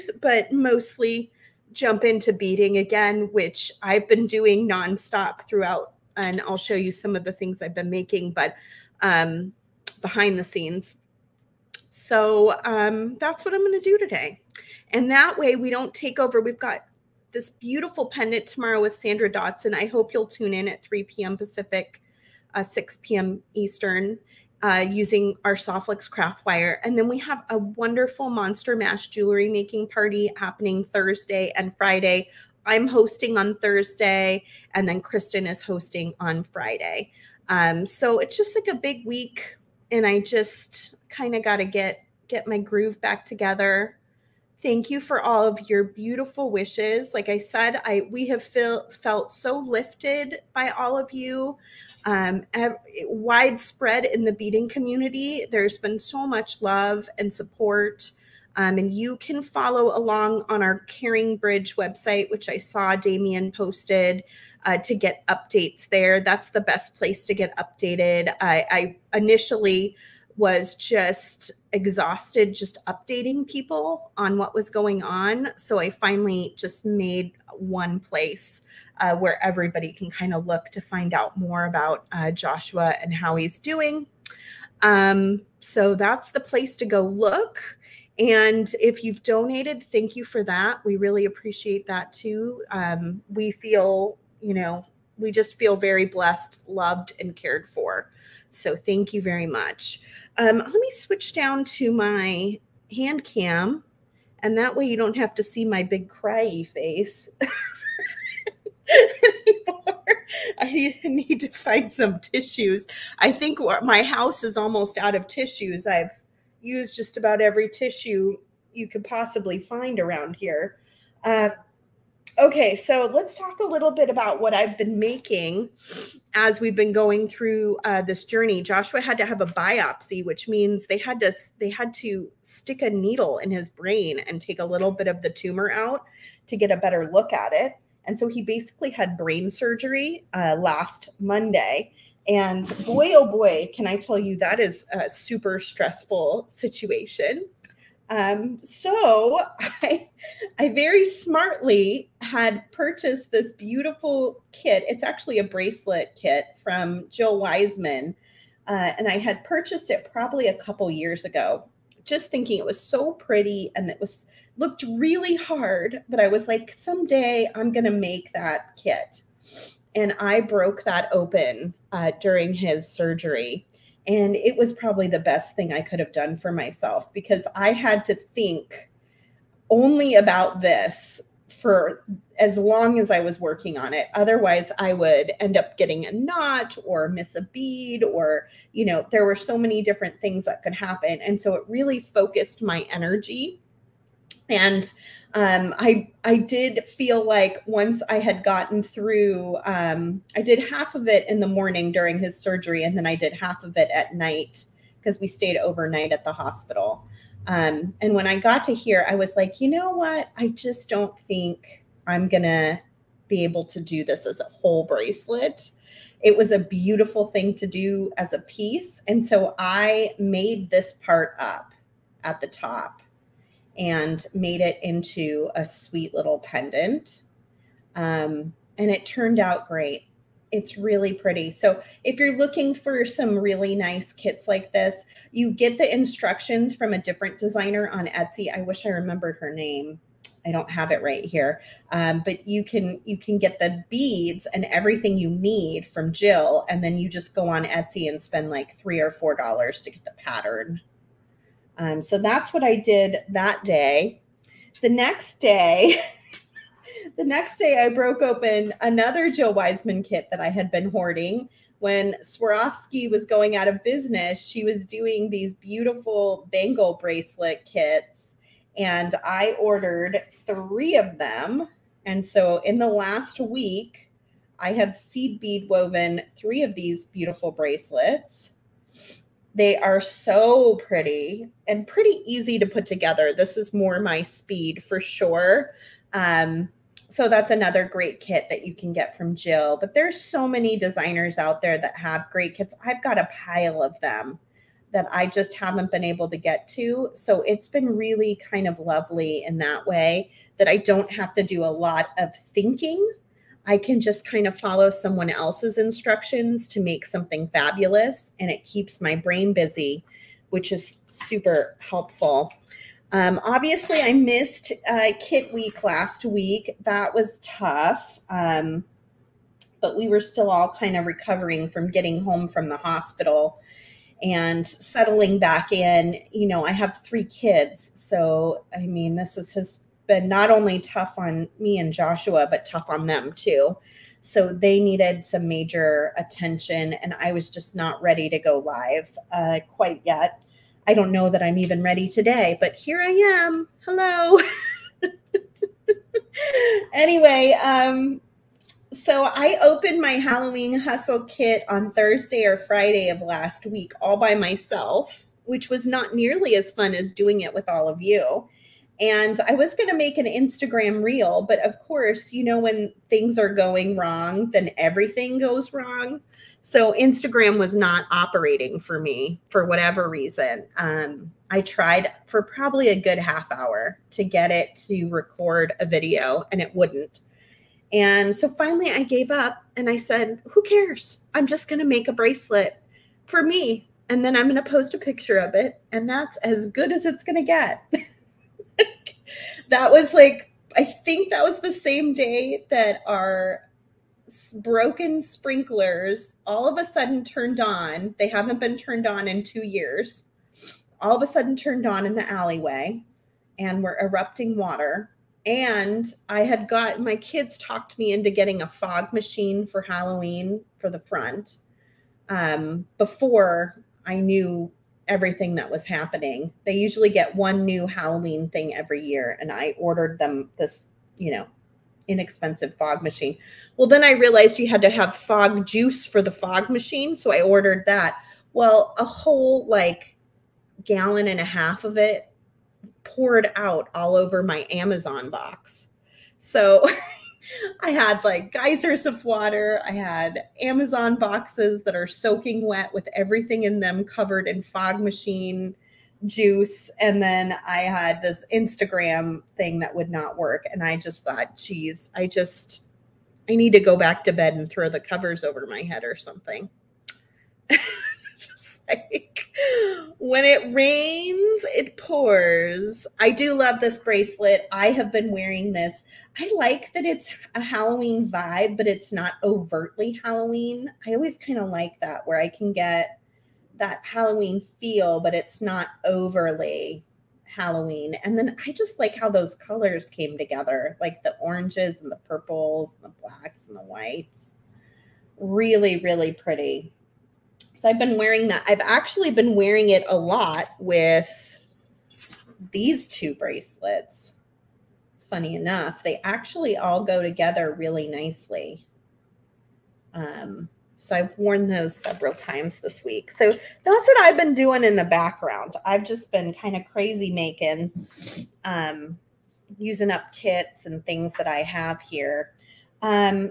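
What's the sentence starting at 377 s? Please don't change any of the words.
And so finally I gave up and I said, Who cares?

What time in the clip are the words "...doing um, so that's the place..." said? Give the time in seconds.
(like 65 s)
83 s.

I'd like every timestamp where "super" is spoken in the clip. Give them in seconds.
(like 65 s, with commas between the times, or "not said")
145 s, 311 s.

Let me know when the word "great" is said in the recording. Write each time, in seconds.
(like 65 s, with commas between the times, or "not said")
229 s, 287 s, 292 s.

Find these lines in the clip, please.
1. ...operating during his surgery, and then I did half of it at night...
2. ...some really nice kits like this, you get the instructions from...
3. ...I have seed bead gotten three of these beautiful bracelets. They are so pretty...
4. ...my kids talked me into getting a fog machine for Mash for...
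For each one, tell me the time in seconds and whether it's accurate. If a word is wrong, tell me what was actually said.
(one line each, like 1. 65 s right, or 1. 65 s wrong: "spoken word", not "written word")
1. 201 s wrong: "morning", not "operating"
2. 233 s right
3. 274 s wrong: "woven", not "gotten"
4. 406 s wrong: "Halloween", not "Mash".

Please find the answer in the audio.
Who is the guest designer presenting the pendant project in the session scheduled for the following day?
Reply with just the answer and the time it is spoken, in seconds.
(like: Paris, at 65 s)
Sandra Dotson, at 18 s.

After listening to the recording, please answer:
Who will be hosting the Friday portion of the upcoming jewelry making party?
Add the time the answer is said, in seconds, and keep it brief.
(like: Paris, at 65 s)
Kristen, at 34 s.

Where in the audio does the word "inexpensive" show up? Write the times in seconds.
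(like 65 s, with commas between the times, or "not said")
422 s.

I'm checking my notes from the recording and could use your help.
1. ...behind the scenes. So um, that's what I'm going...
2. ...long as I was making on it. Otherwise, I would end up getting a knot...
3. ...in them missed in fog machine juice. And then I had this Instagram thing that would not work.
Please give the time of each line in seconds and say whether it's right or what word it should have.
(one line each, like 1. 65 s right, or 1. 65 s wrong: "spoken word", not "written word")
1. 9 s right
2. 182 s wrong: "working", not "making"
3. 443 s wrong: "covered", not "missed".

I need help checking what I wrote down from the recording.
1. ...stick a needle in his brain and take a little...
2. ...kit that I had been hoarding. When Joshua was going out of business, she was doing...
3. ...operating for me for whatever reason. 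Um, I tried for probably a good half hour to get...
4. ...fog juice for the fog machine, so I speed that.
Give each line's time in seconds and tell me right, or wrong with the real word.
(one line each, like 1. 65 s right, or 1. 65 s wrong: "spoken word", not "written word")
1. 132 s right
2. 260 s wrong: "Swarovski", not "Joshua"
3. 368 s right
4. 425 s wrong: "ordered", not "speed".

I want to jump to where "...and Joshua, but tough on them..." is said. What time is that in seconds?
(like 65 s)
331 s.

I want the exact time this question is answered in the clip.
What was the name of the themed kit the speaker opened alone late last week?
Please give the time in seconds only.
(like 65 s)
350 s.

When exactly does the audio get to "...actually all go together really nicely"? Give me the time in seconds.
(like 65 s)
496 s.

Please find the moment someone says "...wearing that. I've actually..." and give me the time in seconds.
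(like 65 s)
488 s.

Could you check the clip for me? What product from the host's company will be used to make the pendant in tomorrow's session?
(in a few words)
Soft Flex craft wire.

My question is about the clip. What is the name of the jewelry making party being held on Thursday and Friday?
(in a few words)
Monster Mash.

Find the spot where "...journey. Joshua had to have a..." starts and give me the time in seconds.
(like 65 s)
128 s.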